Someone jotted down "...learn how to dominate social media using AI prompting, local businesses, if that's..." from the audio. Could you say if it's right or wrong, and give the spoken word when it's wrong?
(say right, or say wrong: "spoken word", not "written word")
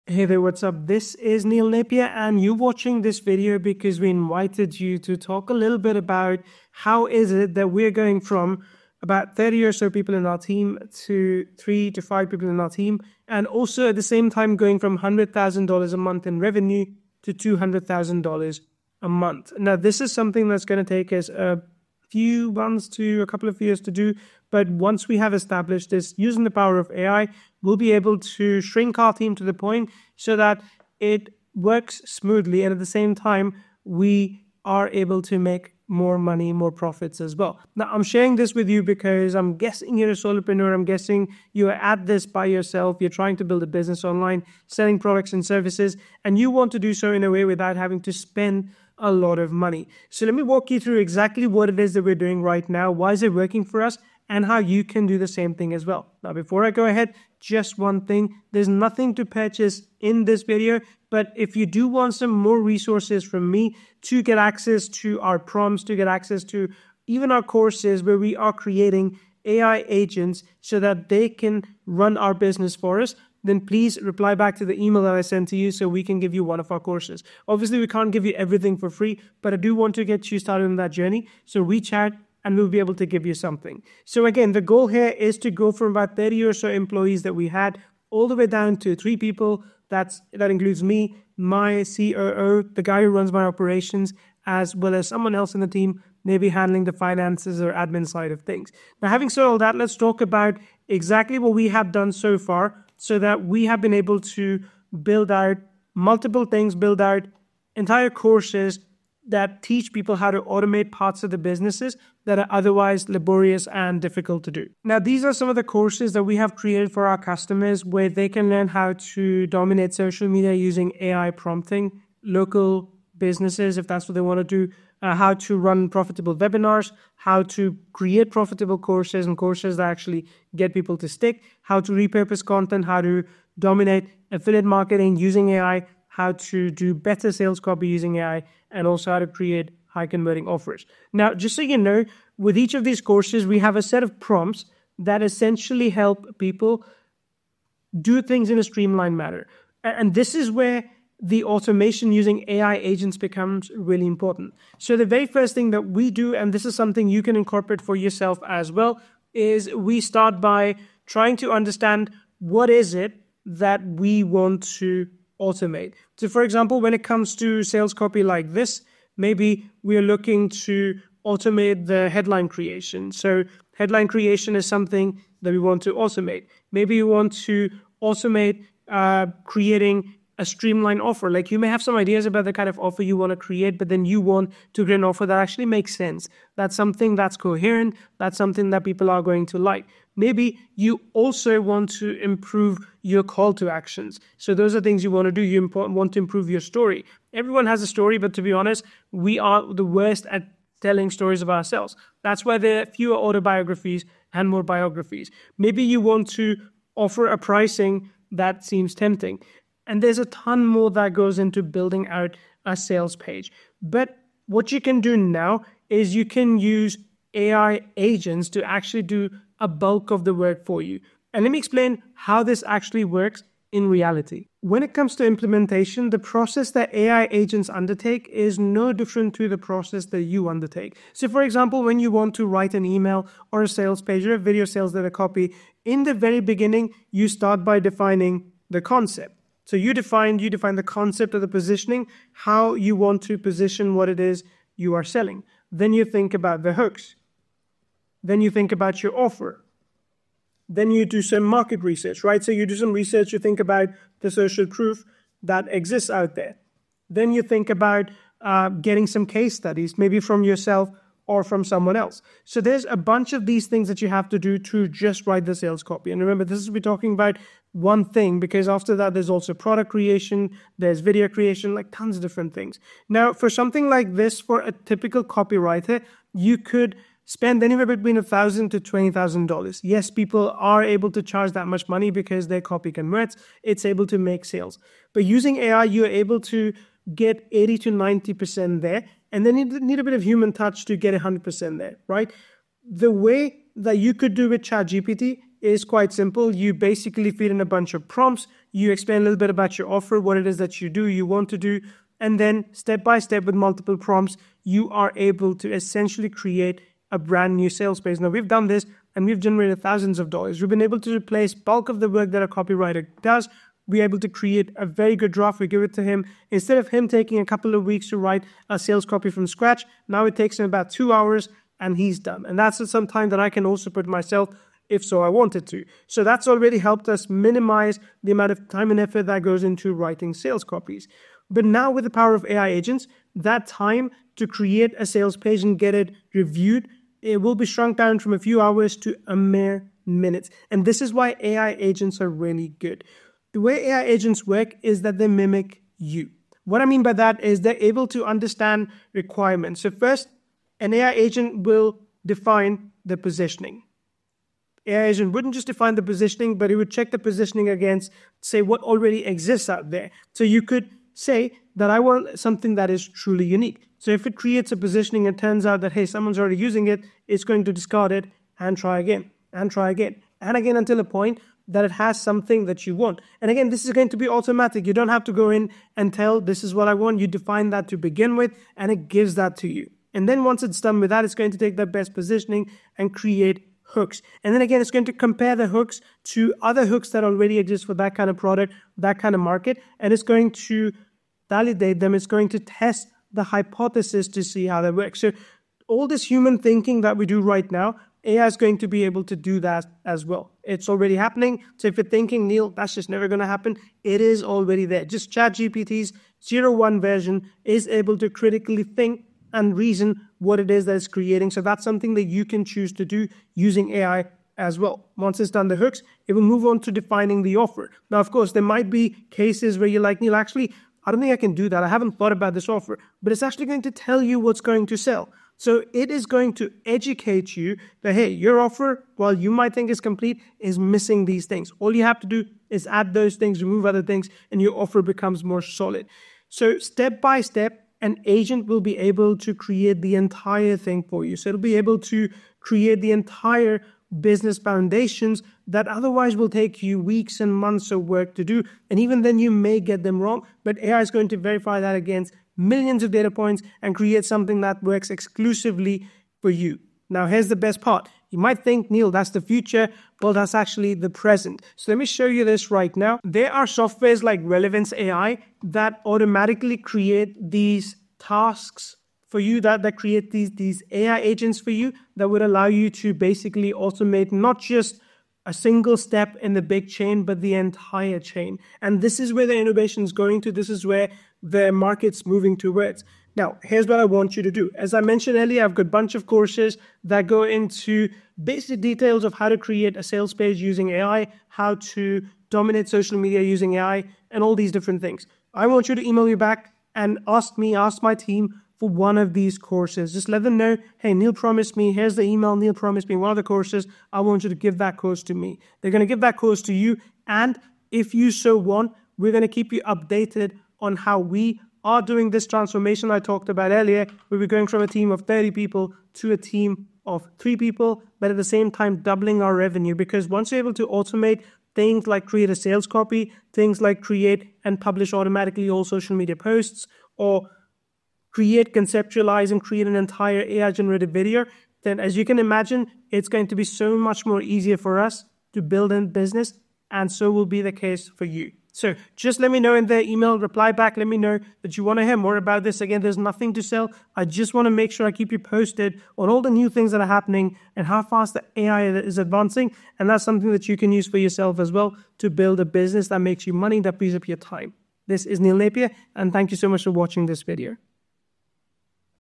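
right.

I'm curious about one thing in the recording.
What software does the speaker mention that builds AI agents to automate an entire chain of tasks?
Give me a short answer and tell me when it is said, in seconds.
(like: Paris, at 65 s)
Relevance AI, at 464 s.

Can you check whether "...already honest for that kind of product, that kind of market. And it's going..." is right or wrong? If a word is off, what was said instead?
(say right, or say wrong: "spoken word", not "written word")
wrong: "exist", not "honest".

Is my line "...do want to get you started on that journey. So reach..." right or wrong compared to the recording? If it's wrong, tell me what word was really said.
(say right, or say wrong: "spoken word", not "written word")
right.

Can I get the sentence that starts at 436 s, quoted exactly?
So step by step, an agent will be able to create the entire thing for you.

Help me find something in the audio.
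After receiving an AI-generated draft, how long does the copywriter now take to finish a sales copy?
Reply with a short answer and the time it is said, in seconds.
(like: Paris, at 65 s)
About two hours, at 320 s.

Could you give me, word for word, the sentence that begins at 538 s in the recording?
So just let me know in the email reply back.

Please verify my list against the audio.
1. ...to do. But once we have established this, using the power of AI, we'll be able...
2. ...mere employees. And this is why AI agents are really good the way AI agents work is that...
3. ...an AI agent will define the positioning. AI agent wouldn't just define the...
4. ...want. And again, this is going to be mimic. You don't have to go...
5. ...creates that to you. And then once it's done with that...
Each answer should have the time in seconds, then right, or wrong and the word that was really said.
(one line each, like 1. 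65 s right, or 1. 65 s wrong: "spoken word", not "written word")
1. 23 s right
2. 339 s wrong: "minutes", not "employees"
3. 350 s right
4. 372 s wrong: "automatic", not "mimic"
5. 379 s wrong: "gives", not "creates".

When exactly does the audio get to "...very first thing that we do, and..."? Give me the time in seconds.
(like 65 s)
155 s.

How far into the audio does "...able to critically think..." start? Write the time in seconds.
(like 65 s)
407 s.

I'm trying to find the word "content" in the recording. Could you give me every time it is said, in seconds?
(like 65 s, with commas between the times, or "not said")
132 s.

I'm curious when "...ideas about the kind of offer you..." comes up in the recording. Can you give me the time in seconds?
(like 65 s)
181 s.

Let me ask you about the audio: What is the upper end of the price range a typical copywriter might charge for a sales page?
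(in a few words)
$20,000.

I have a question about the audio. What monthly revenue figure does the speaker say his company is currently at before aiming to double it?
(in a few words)
$100,000.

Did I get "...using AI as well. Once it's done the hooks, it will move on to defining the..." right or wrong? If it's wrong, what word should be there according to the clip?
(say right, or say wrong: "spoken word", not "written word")
right.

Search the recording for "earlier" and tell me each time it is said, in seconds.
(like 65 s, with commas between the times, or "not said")
485 s, 513 s.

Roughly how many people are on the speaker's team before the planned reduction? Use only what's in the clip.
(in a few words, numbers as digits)
30.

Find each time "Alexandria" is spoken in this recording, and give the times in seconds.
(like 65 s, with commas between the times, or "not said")
not said.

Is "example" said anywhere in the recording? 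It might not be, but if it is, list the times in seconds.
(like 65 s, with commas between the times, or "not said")
166 s, 231 s.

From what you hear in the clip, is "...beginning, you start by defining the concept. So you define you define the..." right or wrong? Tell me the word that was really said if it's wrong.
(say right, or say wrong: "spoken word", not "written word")
right.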